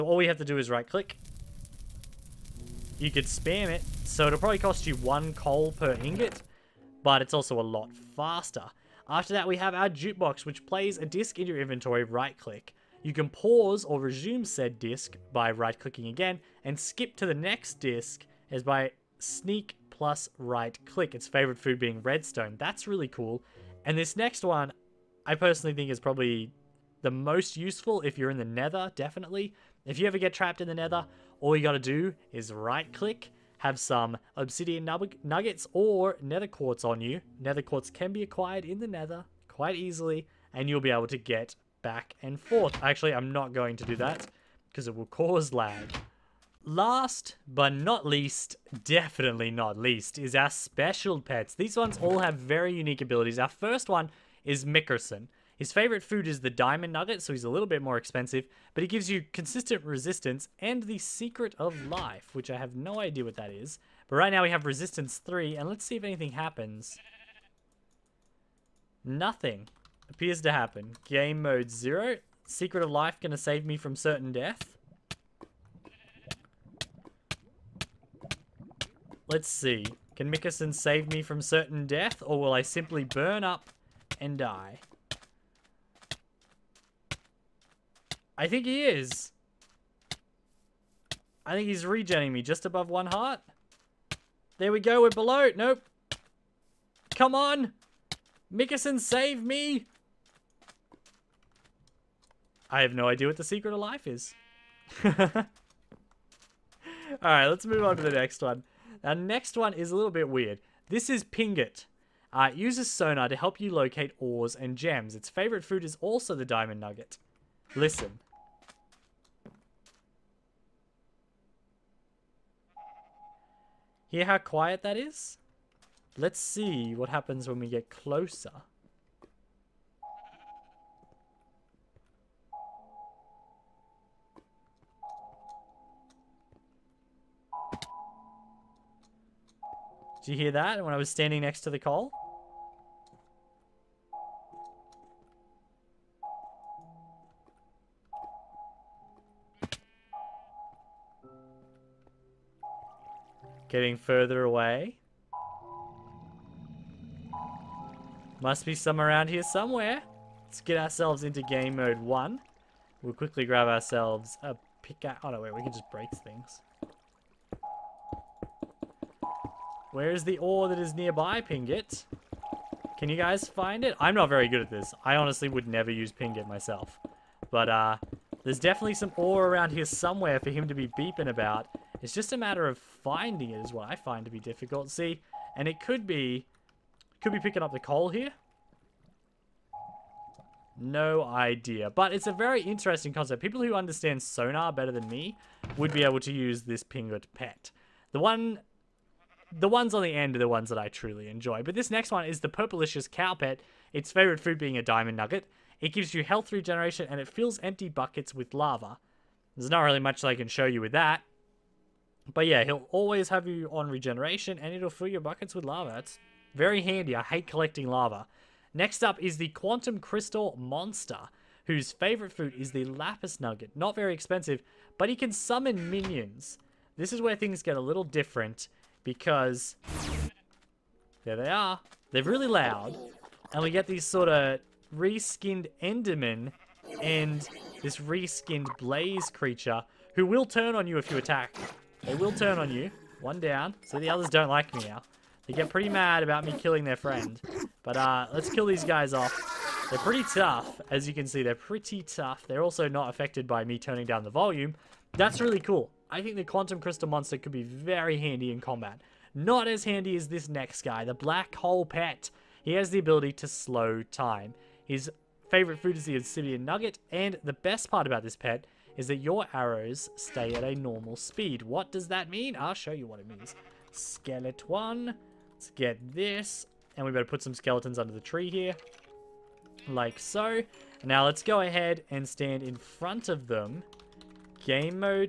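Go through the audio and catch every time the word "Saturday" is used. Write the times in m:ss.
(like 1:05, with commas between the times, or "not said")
not said.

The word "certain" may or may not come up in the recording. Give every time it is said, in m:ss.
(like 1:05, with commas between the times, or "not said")
1:13, 1:21.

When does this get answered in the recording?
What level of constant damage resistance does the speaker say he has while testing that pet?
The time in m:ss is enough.
1:04.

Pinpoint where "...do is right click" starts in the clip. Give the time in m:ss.
0:00.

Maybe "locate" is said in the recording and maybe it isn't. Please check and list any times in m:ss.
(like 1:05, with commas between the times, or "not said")
1:53.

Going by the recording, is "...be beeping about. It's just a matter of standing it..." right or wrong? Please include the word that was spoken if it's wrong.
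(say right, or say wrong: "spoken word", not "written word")
wrong: "finding", not "standing".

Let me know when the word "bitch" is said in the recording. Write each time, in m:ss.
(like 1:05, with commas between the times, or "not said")
not said.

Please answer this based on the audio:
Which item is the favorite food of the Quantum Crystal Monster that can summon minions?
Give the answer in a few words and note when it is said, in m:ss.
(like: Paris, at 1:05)
Lapis Nugget, at 3:42.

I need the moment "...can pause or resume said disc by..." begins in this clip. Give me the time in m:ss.
0:13.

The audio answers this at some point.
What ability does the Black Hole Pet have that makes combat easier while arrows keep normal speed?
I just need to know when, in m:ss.
4:23.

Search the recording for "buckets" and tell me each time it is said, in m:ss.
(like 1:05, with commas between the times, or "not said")
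3:27, 3:35.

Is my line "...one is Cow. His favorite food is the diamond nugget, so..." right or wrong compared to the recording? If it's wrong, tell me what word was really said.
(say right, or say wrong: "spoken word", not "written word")
wrong: "Mickerson", not "Cow".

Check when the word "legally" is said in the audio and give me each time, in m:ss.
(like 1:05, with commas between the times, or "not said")
not said.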